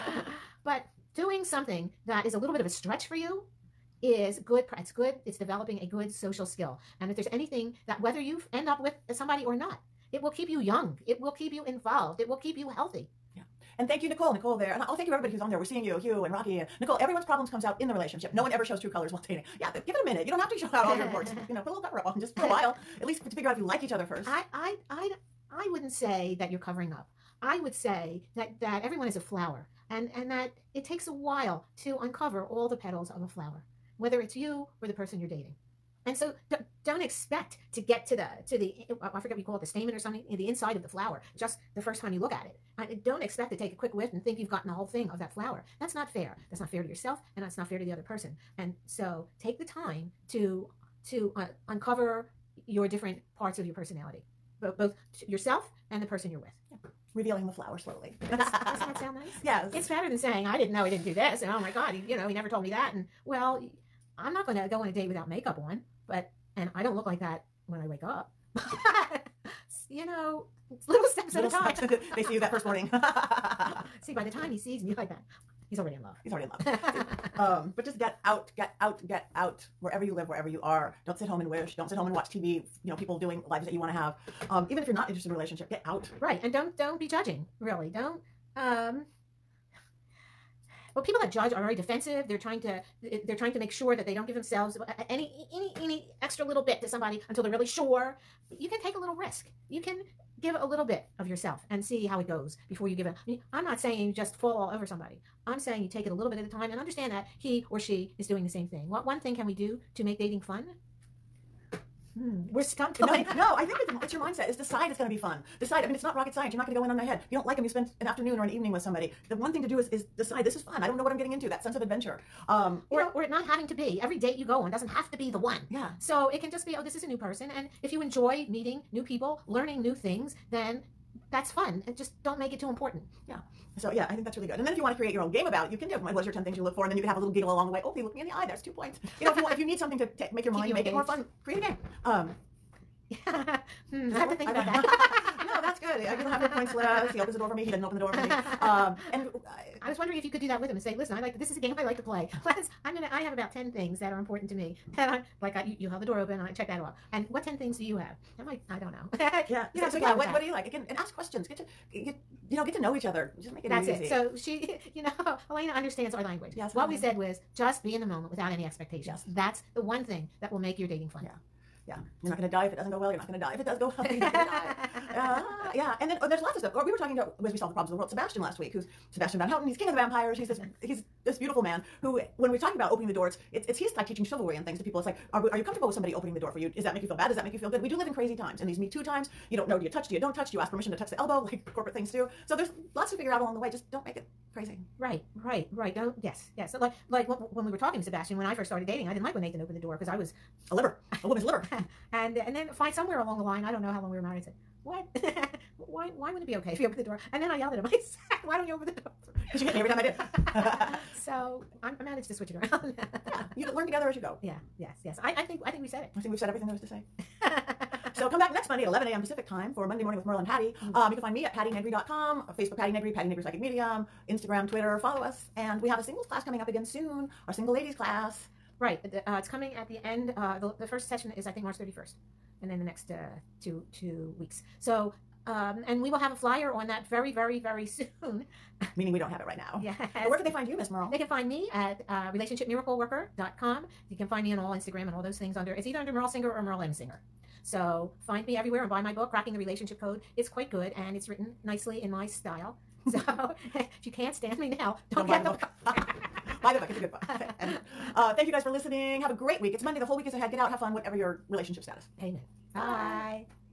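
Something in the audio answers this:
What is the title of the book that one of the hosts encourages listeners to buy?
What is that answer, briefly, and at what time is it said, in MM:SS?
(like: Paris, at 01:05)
Cracking the Relationship Code, at 04:09.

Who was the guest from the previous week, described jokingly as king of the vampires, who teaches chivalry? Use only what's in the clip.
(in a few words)
Sebastian Van Houten.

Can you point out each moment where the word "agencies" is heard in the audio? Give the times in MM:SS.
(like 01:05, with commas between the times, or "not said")
not said.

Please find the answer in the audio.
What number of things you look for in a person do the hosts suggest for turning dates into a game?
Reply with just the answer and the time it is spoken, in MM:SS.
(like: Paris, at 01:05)
10, at 02:16.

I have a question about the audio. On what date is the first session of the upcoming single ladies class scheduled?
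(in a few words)
March 31st.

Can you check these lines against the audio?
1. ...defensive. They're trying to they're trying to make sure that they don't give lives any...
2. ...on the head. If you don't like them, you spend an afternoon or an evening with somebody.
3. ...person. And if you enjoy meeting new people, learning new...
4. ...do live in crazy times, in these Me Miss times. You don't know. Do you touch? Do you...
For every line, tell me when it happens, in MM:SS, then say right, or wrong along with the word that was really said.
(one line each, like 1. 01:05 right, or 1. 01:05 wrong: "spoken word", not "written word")
1. 01:31 wrong: "themselves", not "lives"
2. 01:56 right
3. 02:07 right
4. 03:07 wrong: "Too", not "Miss".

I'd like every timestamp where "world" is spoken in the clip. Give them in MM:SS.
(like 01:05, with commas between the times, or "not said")
02:57.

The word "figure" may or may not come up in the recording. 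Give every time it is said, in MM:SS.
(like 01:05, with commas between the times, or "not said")
00:23, 03:13.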